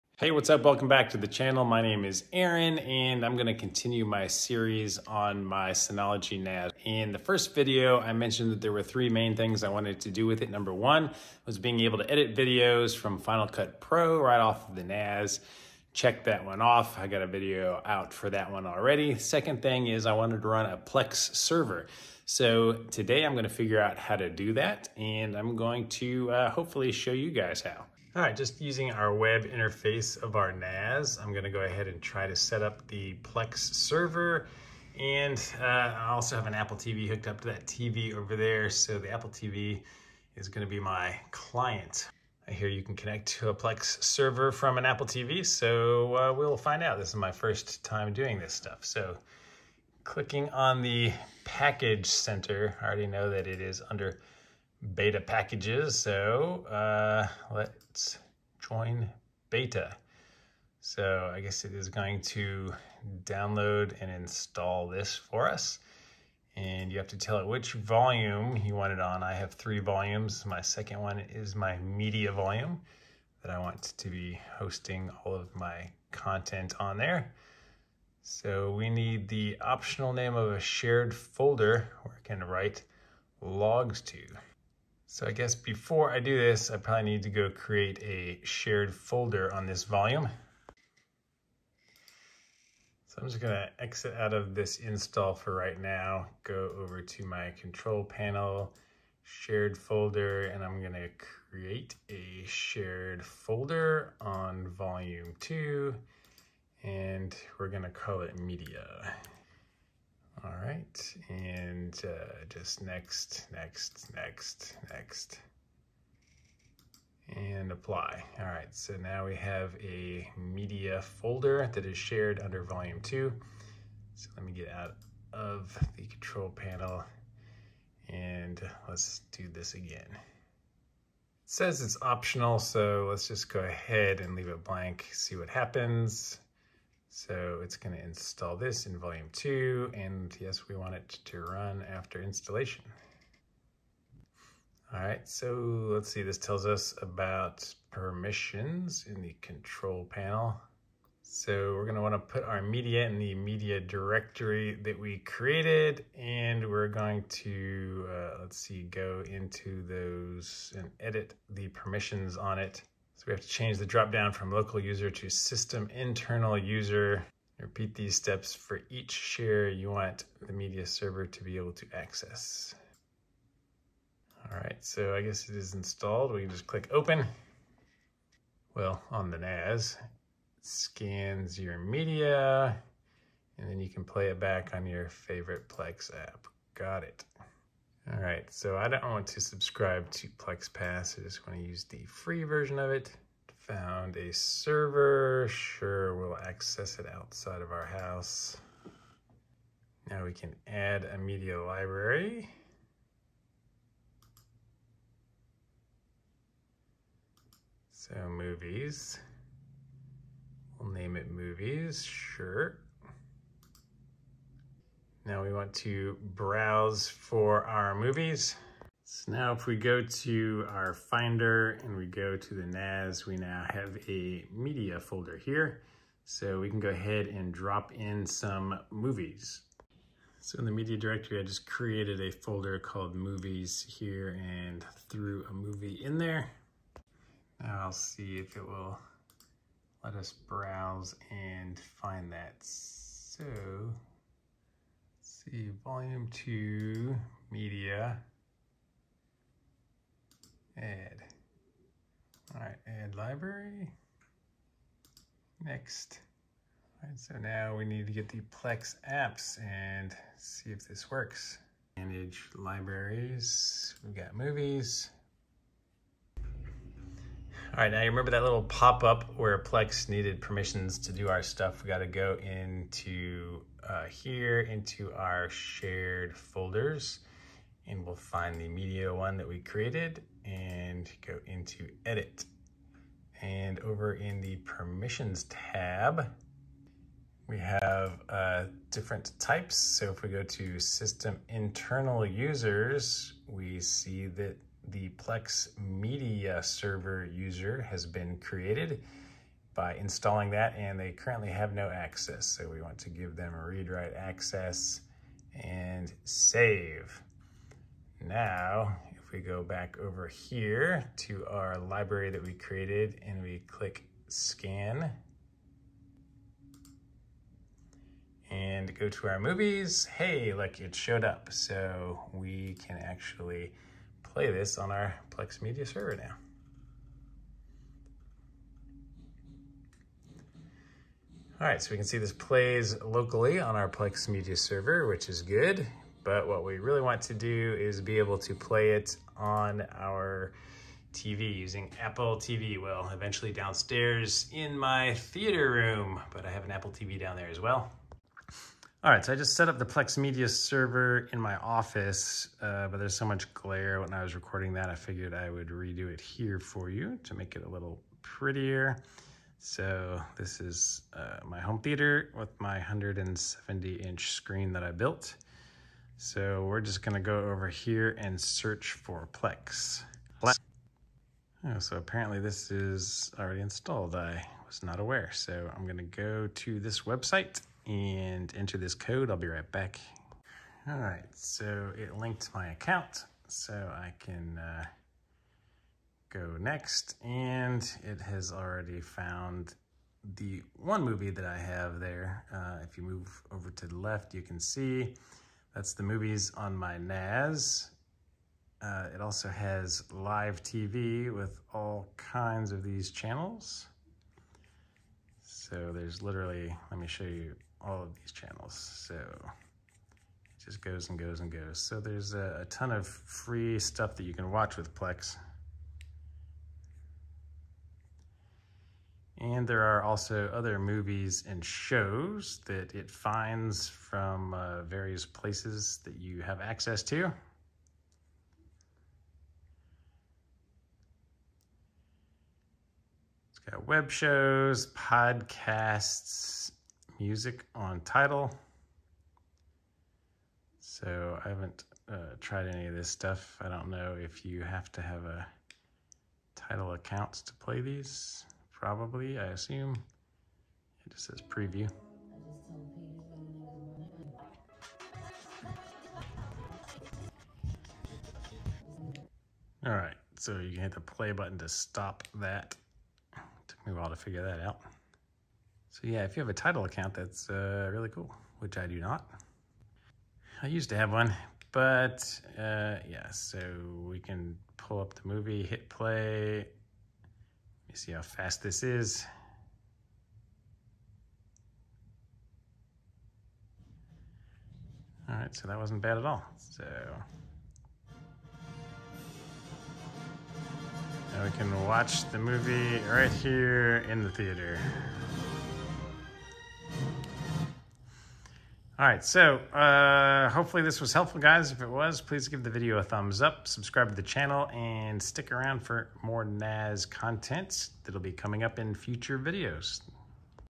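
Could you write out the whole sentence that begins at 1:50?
All right, and uh, just next, next, next, next, and apply.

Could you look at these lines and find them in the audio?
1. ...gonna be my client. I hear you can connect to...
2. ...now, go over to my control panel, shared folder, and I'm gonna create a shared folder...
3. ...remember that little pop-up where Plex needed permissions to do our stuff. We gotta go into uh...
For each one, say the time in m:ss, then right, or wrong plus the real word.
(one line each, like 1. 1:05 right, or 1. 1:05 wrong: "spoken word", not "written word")
1. 0:40 right
2. 1:35 right
3. 4:28 right.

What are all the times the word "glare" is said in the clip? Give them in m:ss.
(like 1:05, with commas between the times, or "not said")
5:53.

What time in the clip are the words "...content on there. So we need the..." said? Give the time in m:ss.
1:16.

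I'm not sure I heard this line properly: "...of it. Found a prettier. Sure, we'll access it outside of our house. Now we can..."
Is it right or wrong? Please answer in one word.
wrong.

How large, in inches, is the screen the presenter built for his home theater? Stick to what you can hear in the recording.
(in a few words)
170.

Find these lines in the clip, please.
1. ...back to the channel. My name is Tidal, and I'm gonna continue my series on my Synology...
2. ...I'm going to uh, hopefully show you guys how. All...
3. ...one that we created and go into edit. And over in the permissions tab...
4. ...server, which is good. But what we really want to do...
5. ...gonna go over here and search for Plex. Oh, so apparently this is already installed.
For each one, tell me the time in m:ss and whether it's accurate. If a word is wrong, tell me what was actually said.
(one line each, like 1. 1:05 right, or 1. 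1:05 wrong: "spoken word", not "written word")
1. 0:00 wrong: "Aaron", not "Tidal"
2. 0:25 right
3. 4:39 right
4. 5:34 right
5. 6:07 right.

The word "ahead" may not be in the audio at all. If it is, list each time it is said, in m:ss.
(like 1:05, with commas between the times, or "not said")
0:31, 2:13, 3:46.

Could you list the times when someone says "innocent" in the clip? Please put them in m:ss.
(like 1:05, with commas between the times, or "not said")
not said.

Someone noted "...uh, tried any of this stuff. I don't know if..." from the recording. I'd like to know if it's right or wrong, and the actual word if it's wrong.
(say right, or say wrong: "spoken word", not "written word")
right.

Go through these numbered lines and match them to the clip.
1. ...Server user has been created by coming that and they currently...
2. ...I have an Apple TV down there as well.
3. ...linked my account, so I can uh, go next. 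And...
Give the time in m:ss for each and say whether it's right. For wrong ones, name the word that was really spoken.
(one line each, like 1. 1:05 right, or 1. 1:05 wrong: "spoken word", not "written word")
1. 4:56 wrong: "installing", not "coming"
2. 5:46 right
3. 6:22 right.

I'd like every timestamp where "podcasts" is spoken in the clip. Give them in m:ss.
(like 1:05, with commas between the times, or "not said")
7:14.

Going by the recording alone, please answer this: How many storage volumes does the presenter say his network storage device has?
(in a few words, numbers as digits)
3.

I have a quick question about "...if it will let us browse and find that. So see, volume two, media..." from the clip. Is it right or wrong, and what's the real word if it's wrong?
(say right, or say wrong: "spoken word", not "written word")
right.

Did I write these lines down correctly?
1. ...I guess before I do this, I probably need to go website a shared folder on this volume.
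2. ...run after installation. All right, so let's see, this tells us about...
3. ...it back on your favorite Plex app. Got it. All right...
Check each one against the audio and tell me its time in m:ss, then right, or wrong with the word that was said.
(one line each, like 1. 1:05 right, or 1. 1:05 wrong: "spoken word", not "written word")
1. 1:25 wrong: "create", not "website"
2. 2:21 right
3. 3:04 right.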